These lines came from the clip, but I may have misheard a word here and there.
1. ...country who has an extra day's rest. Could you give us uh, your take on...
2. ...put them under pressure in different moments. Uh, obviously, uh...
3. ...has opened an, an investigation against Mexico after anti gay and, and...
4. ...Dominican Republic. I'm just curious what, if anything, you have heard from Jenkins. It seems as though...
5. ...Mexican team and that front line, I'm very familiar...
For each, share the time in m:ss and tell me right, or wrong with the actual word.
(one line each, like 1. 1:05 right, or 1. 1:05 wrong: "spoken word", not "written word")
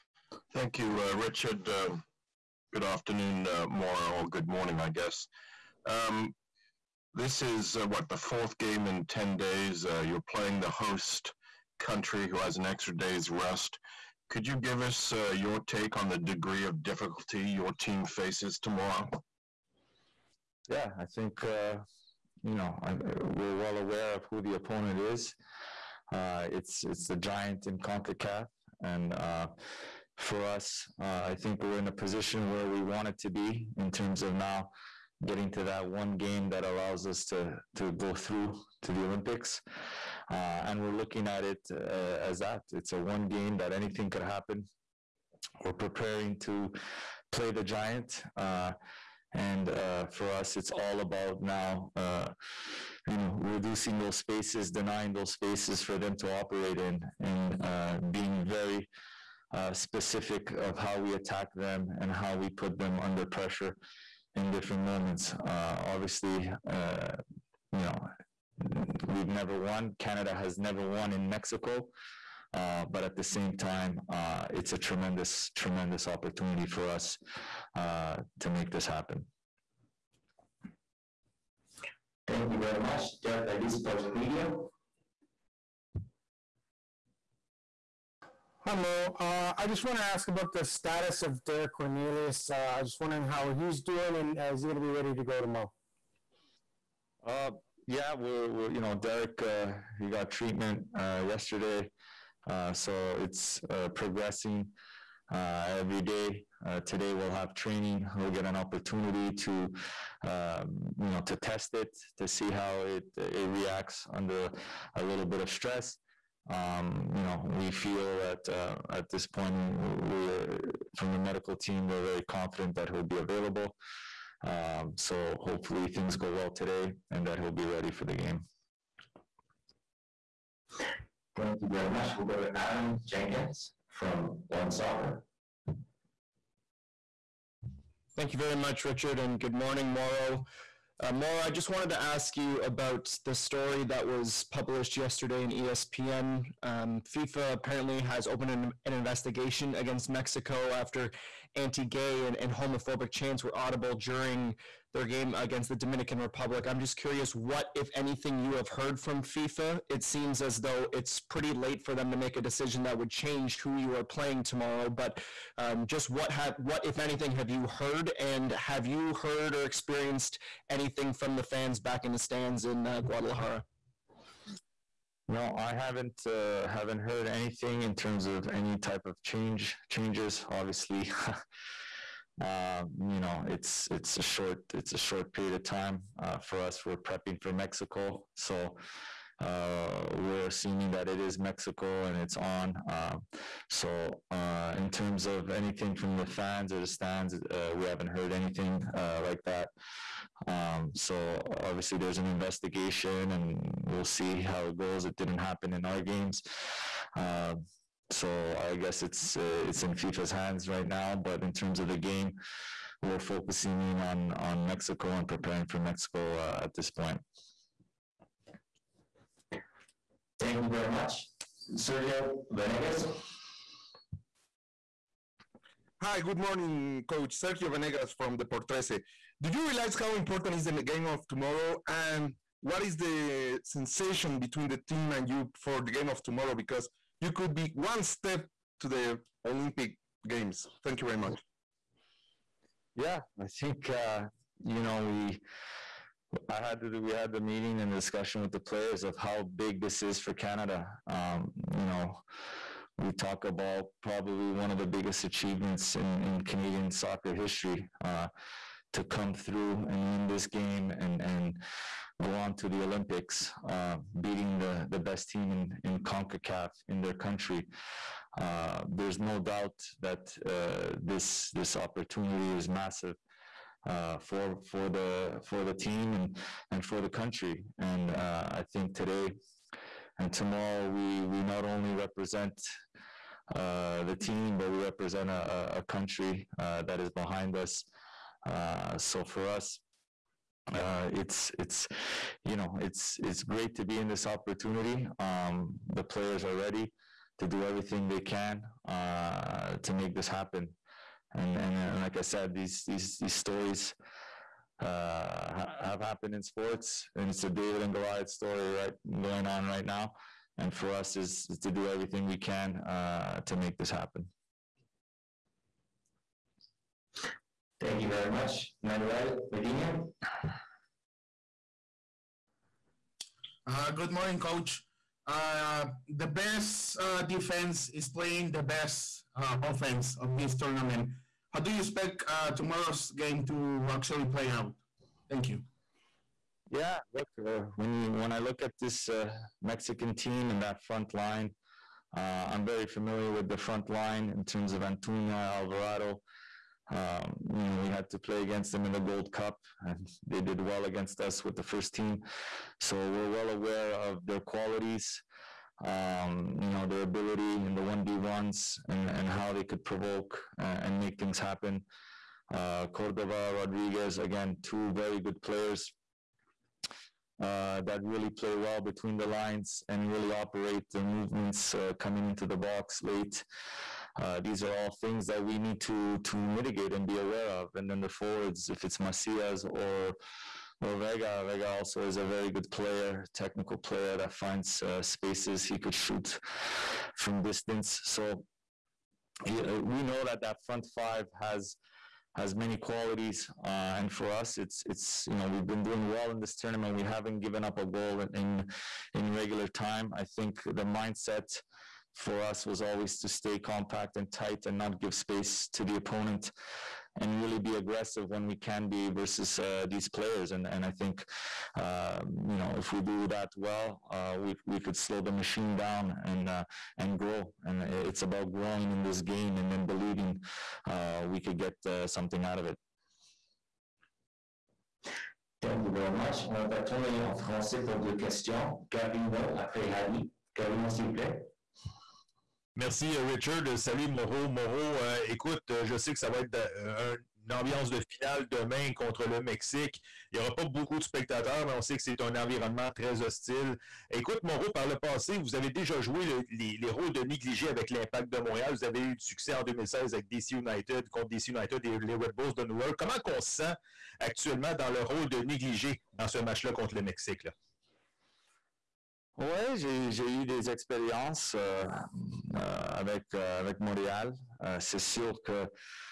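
1. 0:11 right
2. 1:02 right
3. 2:27 right
4. 2:35 wrong: "FIFA", not "Jenkins"
5. 5:39 right.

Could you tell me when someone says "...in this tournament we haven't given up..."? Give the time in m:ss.
6:36.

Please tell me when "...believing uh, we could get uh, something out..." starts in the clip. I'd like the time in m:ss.
6:59.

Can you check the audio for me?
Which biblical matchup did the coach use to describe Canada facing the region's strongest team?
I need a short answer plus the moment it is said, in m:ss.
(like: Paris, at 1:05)
David and Goliath, at 5:07.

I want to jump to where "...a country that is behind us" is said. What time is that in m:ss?
4:45.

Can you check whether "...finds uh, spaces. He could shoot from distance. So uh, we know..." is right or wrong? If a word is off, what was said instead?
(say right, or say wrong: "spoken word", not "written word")
right.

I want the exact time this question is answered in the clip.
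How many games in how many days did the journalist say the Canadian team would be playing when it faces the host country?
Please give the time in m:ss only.
0:08.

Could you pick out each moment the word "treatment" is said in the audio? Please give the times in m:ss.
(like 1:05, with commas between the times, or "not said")
1:40.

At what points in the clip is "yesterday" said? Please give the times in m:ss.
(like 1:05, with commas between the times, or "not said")
1:41, 2:24.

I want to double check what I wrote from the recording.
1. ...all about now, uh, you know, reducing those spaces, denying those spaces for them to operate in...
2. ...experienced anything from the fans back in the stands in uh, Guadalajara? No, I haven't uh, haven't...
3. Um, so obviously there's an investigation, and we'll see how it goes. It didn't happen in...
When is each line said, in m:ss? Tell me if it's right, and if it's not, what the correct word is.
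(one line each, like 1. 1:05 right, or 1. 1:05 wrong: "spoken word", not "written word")
1. 0:50 right
2. 2:49 right
3. 3:20 right.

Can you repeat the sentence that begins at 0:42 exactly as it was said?
It's a one game that anything could happen.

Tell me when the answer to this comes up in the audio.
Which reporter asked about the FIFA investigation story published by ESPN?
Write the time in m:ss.
2:12.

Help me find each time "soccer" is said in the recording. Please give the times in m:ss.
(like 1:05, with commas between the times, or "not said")
2:14, 4:16.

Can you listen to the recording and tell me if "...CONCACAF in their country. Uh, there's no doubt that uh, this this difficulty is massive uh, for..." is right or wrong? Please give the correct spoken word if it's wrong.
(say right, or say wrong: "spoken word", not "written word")
wrong: "opportunity", not "difficulty".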